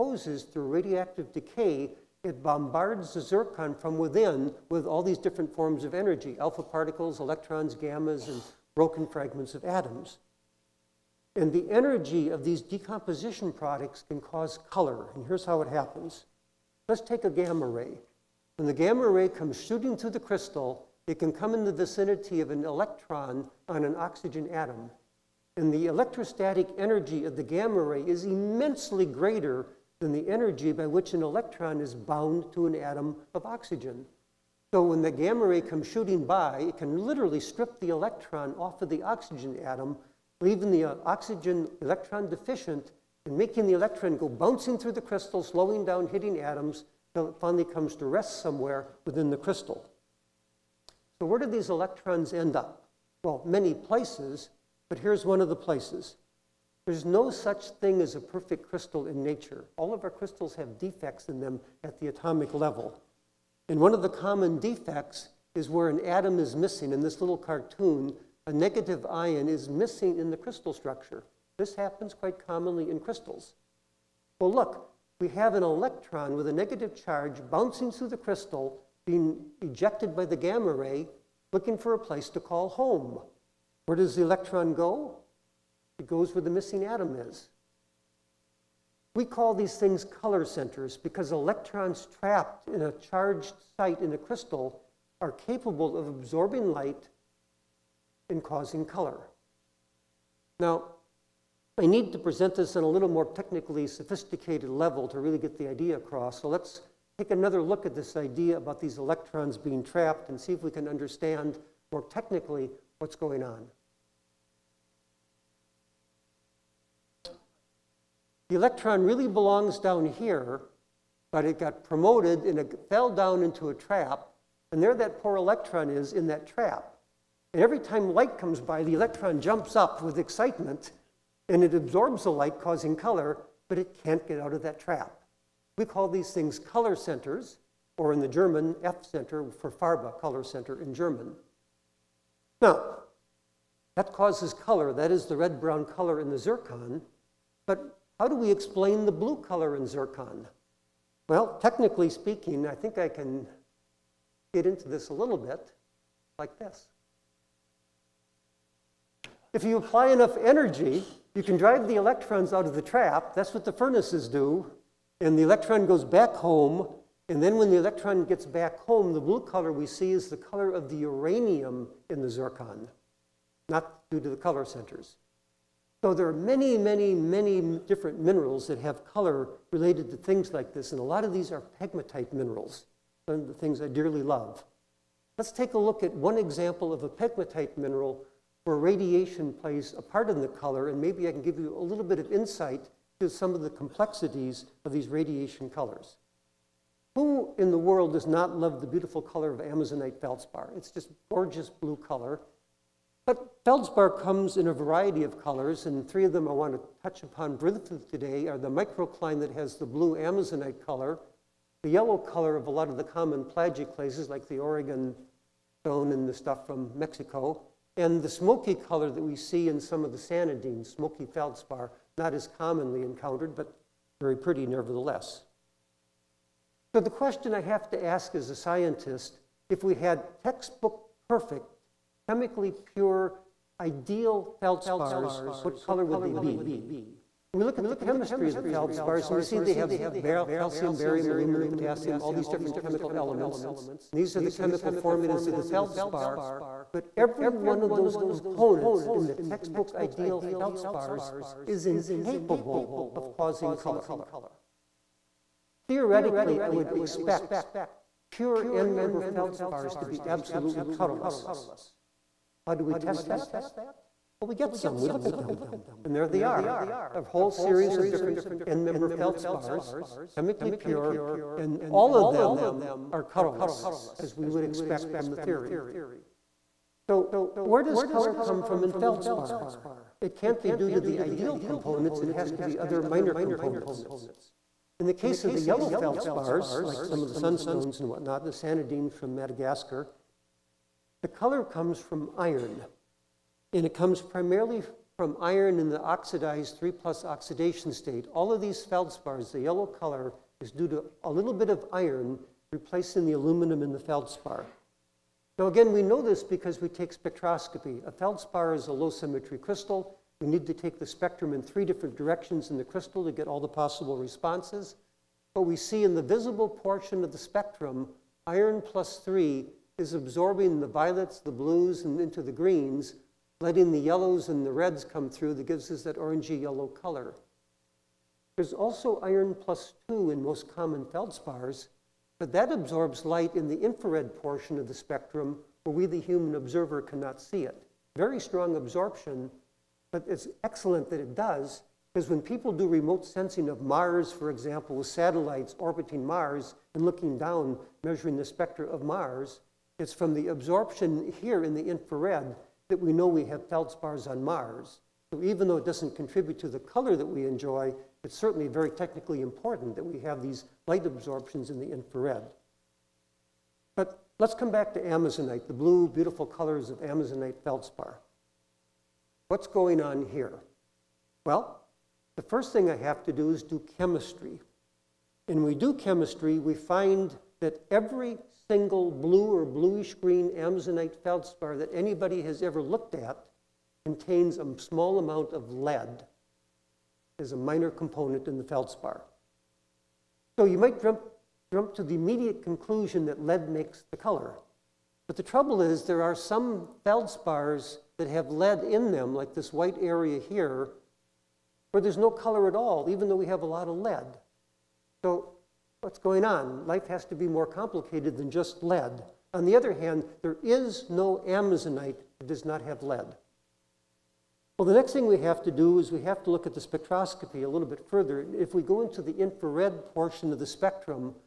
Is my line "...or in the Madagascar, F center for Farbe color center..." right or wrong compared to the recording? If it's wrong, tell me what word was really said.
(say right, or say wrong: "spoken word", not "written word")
wrong: "German", not "Madagascar".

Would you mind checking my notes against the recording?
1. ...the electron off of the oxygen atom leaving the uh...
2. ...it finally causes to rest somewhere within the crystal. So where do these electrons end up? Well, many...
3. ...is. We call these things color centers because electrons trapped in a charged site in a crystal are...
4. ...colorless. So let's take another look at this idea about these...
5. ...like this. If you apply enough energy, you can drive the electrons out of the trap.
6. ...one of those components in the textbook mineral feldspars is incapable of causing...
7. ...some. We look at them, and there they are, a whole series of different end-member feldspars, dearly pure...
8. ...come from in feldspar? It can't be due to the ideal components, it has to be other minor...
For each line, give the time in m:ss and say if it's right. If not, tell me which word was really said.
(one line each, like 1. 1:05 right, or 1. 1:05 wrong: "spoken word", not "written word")
1. 0:37 right
2. 0:47 wrong: "comes", not "causes"
3. 1:27 right
4. 1:45 wrong: "across", not "colorless"
5. 2:36 right
6. 4:07 wrong: "ideal", not "mineral"
7. 4:24 wrong: "chemically", not "dearly"
8. 4:38 right.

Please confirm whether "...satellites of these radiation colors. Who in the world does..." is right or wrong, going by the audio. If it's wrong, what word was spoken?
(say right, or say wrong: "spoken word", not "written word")
wrong: "complexities", not "satellites".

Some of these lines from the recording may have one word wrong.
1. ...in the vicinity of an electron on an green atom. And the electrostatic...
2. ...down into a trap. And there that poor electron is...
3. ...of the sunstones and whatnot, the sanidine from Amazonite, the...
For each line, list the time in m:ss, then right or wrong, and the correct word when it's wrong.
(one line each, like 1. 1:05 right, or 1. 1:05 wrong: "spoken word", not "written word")
1. 0:21 wrong: "oxygen", not "green"
2. 2:03 right
3. 4:47 wrong: "Madagascar", not "Amazonite".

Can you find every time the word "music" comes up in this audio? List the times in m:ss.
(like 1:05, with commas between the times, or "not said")
not said.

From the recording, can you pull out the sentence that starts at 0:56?
There's no such thing as a perfect crystal in nature.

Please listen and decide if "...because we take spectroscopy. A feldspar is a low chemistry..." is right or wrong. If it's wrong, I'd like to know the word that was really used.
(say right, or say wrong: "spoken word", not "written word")
wrong: "symmetry", not "chemistry".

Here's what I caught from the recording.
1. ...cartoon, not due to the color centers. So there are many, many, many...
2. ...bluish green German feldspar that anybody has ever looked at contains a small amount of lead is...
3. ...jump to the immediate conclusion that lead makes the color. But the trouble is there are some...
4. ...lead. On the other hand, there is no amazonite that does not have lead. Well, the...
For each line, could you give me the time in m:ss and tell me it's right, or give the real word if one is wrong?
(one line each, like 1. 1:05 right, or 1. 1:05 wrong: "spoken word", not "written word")
1. 2:52 wrong: "zircon", not "cartoon"
2. 6:19 wrong: "Amazonite", not "German"
3. 6:31 right
4. 6:48 right.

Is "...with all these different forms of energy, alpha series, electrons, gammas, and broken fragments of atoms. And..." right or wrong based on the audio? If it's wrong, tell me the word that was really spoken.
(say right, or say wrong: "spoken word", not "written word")
wrong: "particles", not "series".